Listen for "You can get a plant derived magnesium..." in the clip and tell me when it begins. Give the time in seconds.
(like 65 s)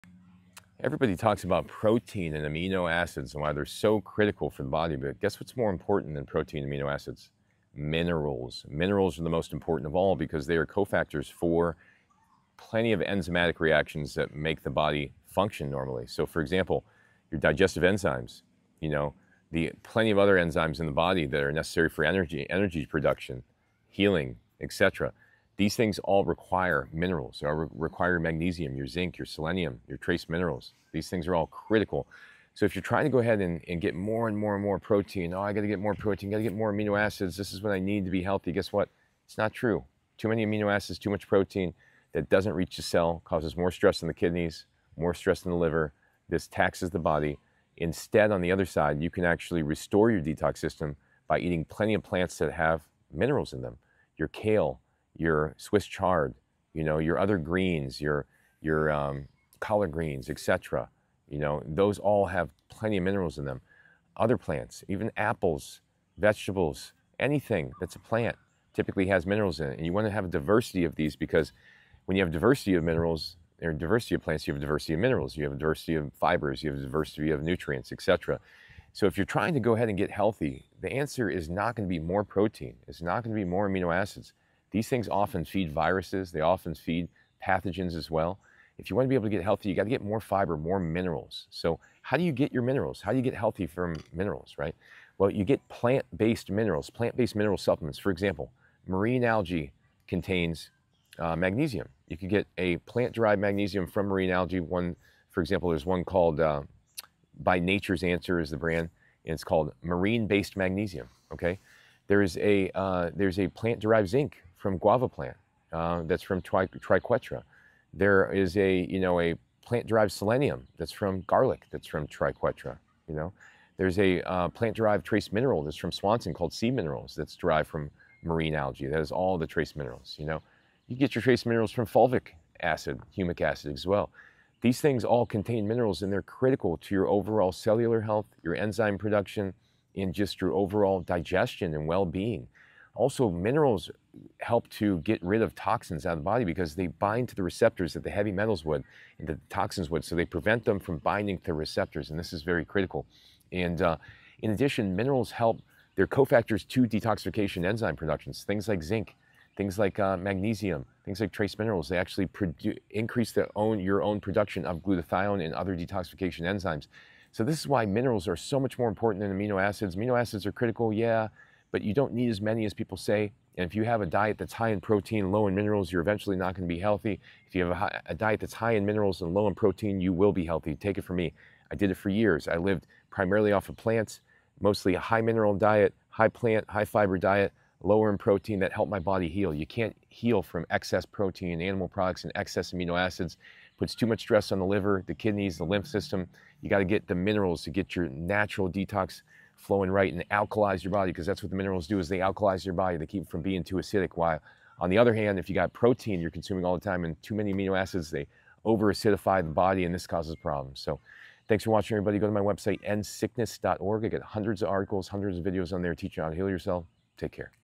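102 s.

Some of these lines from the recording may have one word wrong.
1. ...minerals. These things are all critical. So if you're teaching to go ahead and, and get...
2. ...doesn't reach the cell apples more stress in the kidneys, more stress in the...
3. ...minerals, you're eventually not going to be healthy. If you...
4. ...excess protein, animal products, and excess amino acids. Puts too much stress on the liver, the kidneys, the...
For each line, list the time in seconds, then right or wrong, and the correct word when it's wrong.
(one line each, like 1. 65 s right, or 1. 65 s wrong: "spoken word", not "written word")
1. 30 s wrong: "trying", not "teaching"
2. 42 s wrong: "causes", not "apples"
3. 175 s right
4. 190 s right.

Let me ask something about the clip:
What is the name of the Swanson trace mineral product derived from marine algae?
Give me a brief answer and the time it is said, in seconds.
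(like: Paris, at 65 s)
Sea Minerals, at 126 s.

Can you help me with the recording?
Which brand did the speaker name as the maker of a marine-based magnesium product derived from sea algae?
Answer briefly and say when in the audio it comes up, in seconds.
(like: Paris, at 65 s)
Nature's Answer, at 107 s.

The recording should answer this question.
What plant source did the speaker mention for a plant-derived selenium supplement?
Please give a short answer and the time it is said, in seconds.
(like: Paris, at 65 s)
garlic, at 121 s.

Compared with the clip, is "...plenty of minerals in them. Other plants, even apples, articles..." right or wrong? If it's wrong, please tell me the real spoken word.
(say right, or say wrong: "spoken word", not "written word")
wrong: "vegetables", not "articles".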